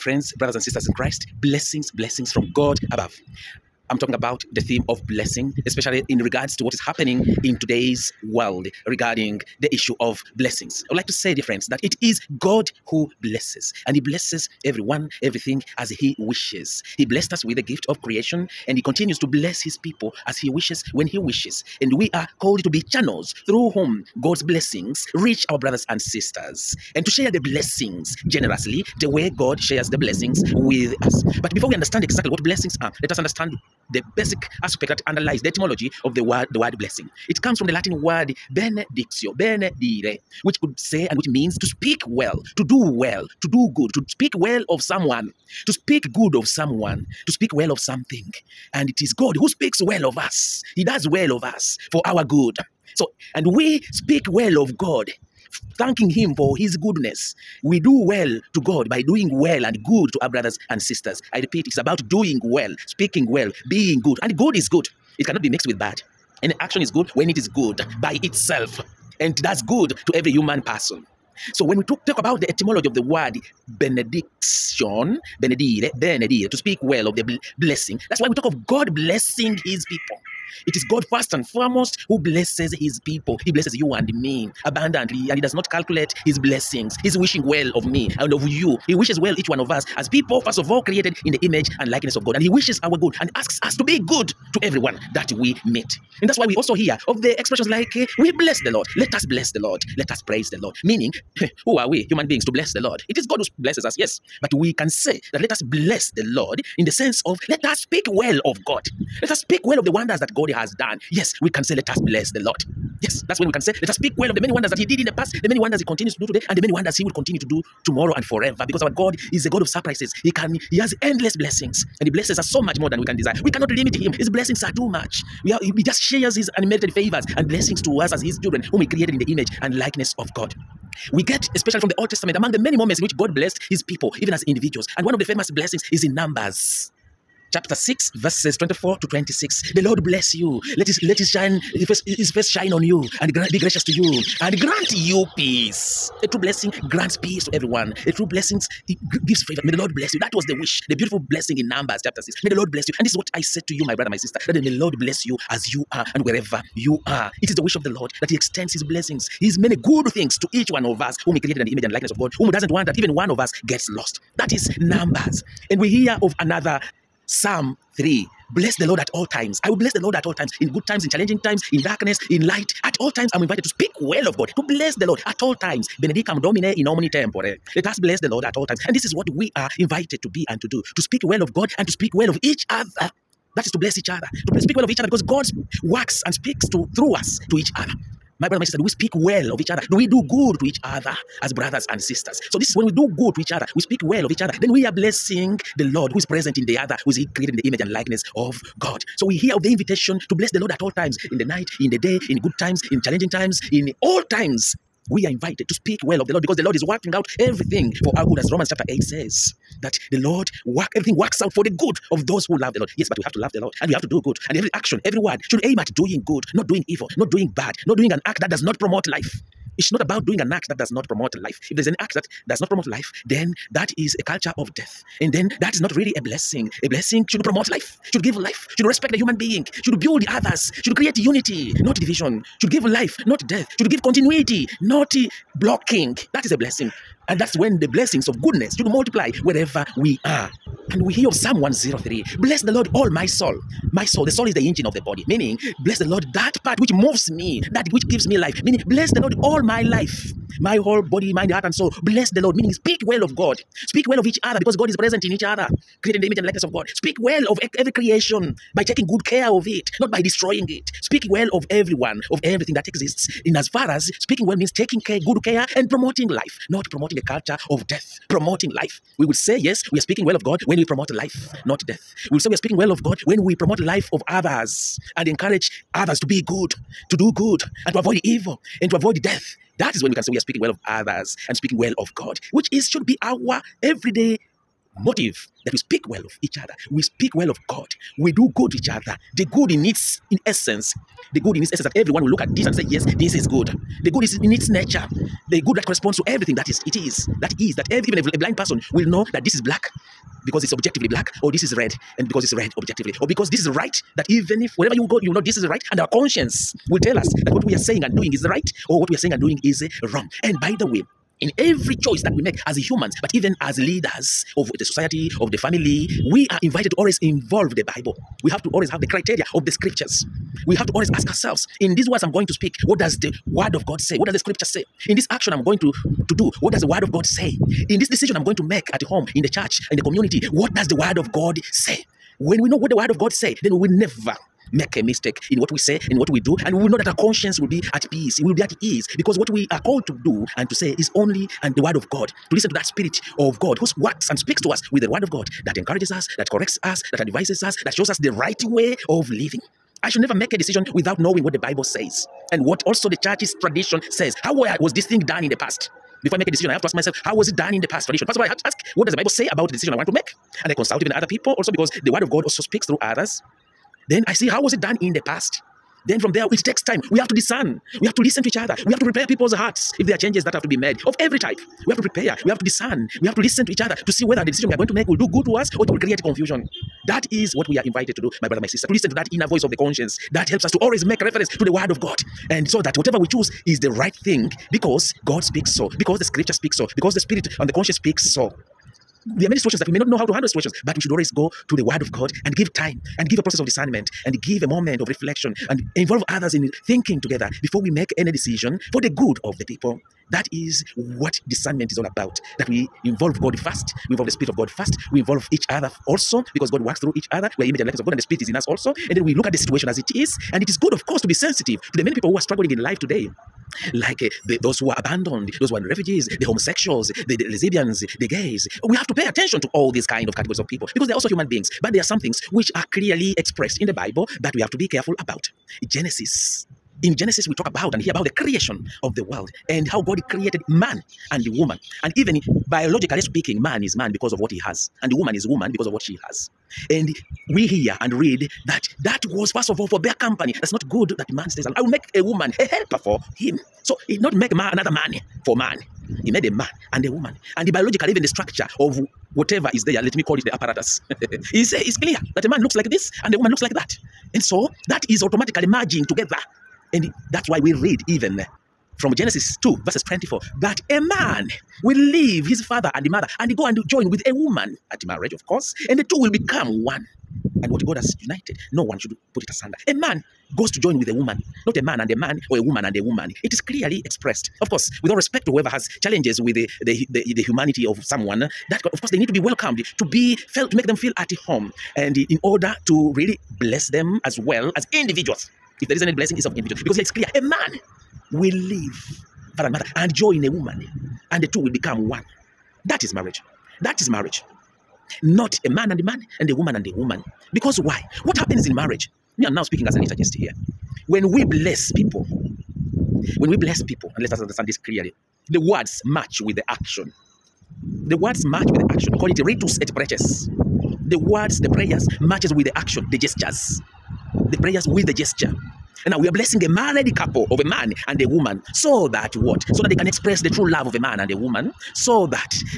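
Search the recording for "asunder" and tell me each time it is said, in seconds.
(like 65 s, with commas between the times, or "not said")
469 s.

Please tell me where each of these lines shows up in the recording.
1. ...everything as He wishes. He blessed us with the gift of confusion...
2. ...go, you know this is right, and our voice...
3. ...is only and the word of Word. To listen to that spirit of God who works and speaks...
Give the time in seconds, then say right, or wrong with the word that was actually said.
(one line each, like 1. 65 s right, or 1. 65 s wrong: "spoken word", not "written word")
1. 15 s wrong: "creation", not "confusion"
2. 305 s wrong: "conscience", not "voice"
3. 340 s wrong: "God", not "Word".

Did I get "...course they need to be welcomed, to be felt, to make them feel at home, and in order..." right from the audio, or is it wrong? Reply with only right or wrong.
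right.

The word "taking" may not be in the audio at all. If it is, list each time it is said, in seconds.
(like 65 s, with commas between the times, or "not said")
258 s, 264 s.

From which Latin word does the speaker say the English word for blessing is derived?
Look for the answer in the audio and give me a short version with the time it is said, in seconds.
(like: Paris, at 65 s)
benedictio, at 38 s.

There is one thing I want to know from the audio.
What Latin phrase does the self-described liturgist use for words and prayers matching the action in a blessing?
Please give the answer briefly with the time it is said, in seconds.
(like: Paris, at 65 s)
ritus et preces, at 509 s.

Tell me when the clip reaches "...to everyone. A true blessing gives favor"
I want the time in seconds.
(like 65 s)
147 s.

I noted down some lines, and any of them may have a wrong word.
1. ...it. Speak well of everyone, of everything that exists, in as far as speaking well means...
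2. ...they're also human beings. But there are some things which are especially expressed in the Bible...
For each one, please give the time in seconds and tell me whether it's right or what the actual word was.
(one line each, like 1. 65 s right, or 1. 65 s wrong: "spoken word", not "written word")
1. 260 s right
2. 421 s wrong: "clearly", not "especially".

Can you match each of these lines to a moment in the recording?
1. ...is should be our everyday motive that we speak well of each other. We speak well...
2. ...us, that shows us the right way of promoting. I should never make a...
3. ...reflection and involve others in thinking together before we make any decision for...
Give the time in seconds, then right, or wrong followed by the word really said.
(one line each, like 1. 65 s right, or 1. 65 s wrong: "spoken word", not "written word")
1. 282 s right
2. 347 s wrong: "living", not "promoting"
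3. 395 s right.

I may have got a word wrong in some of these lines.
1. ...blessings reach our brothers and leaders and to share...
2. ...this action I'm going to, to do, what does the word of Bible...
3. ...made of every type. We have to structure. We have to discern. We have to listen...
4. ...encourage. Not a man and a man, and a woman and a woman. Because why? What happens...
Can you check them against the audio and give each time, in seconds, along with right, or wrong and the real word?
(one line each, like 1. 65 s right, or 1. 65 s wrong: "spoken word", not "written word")
1. 24 s wrong: "sisters", not "leaders"
2. 325 s wrong: "God", not "Bible"
3. 370 s wrong: "prepare", not "structure"
4. 494 s wrong: "marriage", not "encourage".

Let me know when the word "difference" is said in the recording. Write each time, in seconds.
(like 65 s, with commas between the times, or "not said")
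not said.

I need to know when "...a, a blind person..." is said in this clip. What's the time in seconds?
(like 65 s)
298 s.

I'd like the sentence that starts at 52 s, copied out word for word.
So, and we speak well of God, thanking Him for His goodness.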